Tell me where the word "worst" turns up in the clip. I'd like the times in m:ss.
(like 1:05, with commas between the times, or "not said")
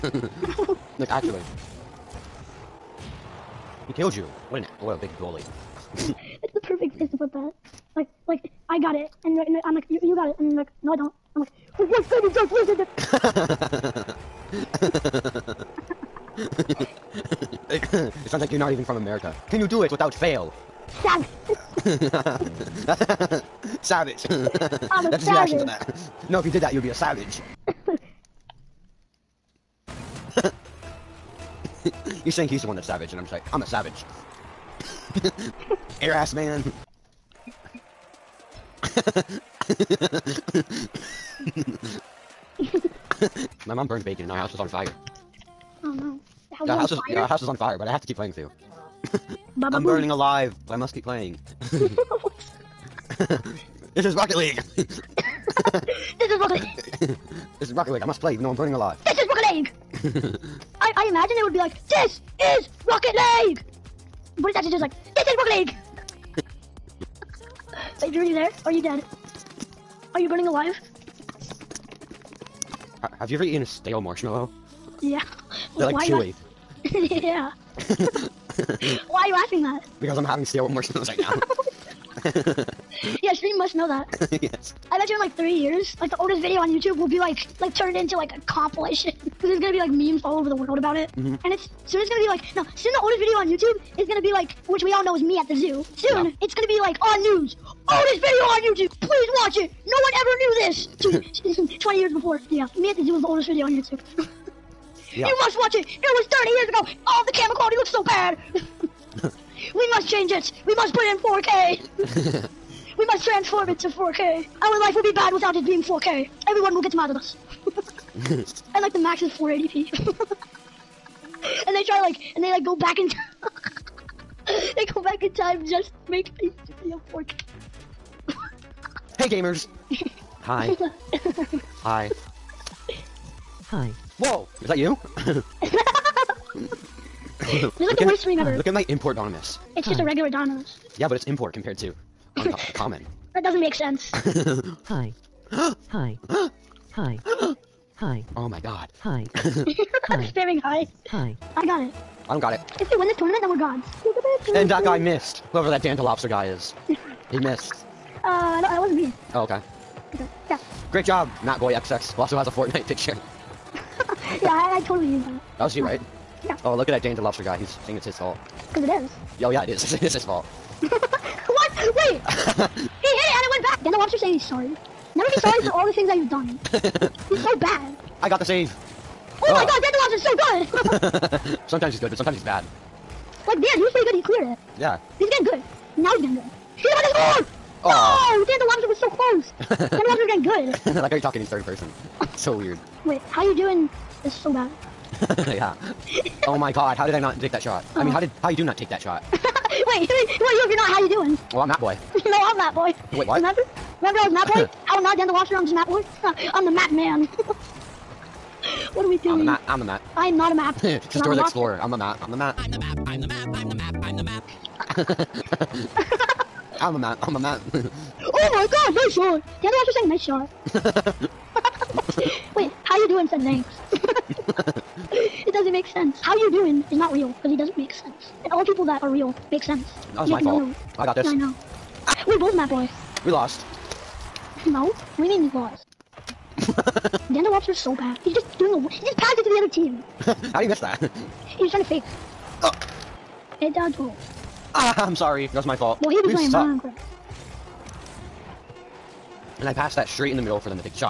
2:18.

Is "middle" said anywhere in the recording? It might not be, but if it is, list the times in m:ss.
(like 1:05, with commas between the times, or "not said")
4:10.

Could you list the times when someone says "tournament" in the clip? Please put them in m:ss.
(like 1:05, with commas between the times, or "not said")
2:33.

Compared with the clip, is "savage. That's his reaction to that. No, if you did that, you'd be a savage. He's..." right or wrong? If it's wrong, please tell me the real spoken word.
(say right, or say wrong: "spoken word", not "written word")
right.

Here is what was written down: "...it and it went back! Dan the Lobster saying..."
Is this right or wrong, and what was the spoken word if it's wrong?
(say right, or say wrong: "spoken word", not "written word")
right.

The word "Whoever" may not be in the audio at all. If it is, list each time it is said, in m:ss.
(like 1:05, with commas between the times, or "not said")
2:35.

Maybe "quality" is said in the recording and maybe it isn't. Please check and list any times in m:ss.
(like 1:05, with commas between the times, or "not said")
1:47.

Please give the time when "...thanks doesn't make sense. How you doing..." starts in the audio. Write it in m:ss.
3:43.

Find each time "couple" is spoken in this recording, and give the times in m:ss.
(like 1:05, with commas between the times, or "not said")
not said.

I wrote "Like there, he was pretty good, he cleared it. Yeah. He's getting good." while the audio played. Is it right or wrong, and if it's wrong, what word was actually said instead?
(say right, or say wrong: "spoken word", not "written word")
right.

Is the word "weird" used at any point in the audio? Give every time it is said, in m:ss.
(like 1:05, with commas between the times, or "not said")
3:12.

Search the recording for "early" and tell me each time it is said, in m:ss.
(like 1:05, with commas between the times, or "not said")
not said.